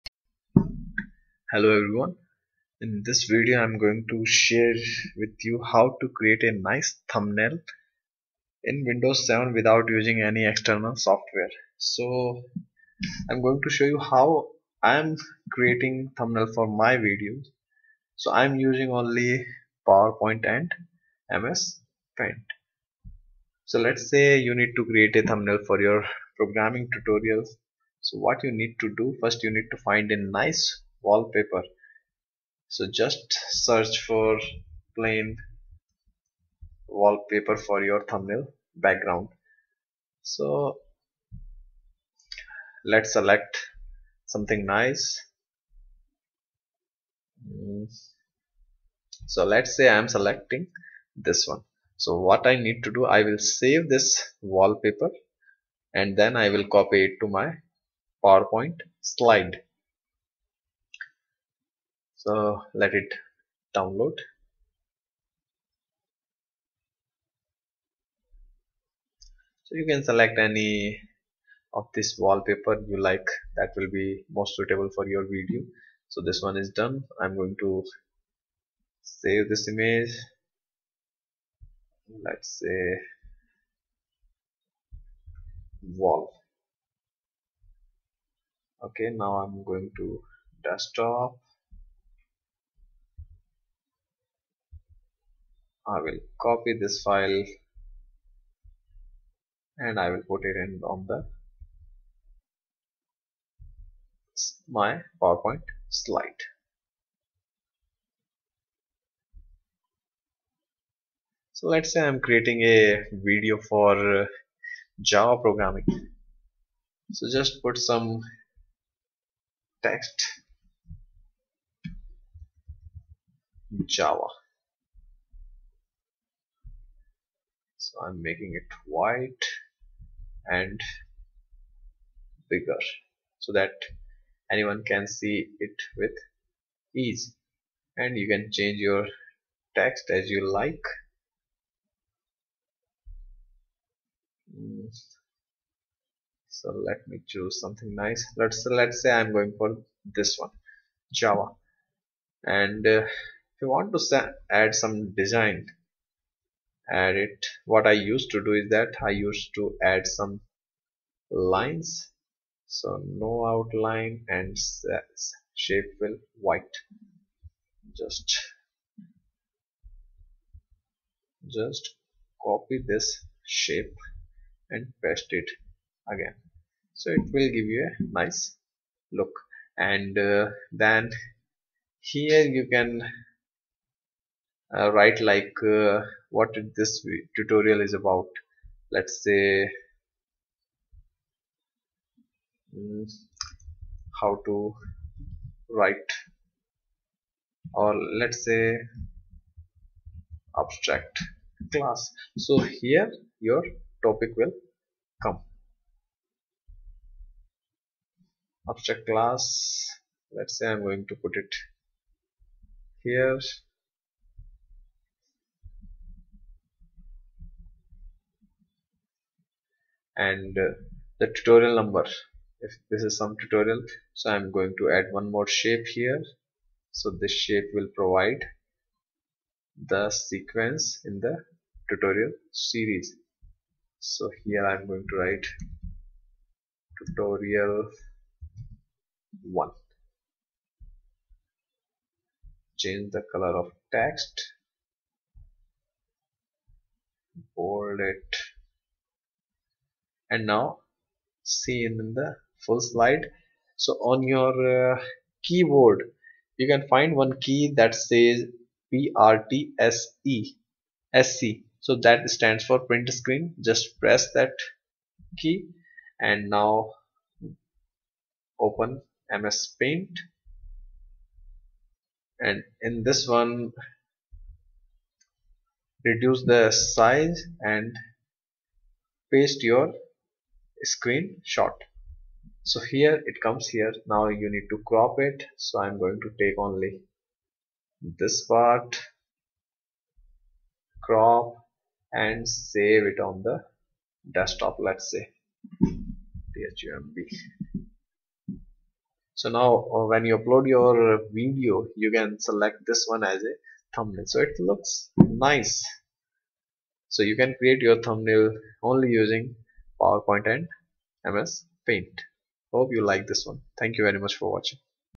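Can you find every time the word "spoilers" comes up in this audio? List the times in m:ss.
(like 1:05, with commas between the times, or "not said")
not said.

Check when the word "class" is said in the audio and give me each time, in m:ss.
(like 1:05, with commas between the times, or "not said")
3:21, 3:29.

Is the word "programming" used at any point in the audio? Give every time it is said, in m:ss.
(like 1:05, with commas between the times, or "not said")
0:26, 1:55.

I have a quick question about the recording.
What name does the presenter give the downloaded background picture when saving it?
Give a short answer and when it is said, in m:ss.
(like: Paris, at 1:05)
wall, at 1:26.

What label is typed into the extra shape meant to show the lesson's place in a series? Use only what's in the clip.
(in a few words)
tutorial 1.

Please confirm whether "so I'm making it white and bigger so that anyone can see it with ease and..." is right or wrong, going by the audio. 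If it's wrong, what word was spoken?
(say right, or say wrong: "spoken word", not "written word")
right.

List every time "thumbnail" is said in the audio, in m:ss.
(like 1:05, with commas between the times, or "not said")
0:07, 0:16, 0:25, 0:38, 5:03, 5:08.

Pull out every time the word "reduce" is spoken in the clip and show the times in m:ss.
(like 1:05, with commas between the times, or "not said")
4:36.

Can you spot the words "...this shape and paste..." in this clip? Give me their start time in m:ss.
2:52.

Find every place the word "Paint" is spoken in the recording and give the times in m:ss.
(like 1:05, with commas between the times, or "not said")
0:22, 4:29, 5:11.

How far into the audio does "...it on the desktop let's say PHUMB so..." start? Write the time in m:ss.
4:53.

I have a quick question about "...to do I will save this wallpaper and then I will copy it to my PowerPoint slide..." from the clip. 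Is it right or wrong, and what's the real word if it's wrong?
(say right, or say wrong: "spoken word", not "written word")
right.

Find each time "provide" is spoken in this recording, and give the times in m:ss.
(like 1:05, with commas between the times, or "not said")
3:47.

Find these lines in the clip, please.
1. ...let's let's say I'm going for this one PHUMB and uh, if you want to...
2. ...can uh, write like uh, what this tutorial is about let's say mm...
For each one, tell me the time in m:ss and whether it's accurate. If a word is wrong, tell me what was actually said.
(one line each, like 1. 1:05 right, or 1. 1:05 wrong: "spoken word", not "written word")
1. 2:28 wrong: "Java", not "PHUMB"
2. 3:02 right.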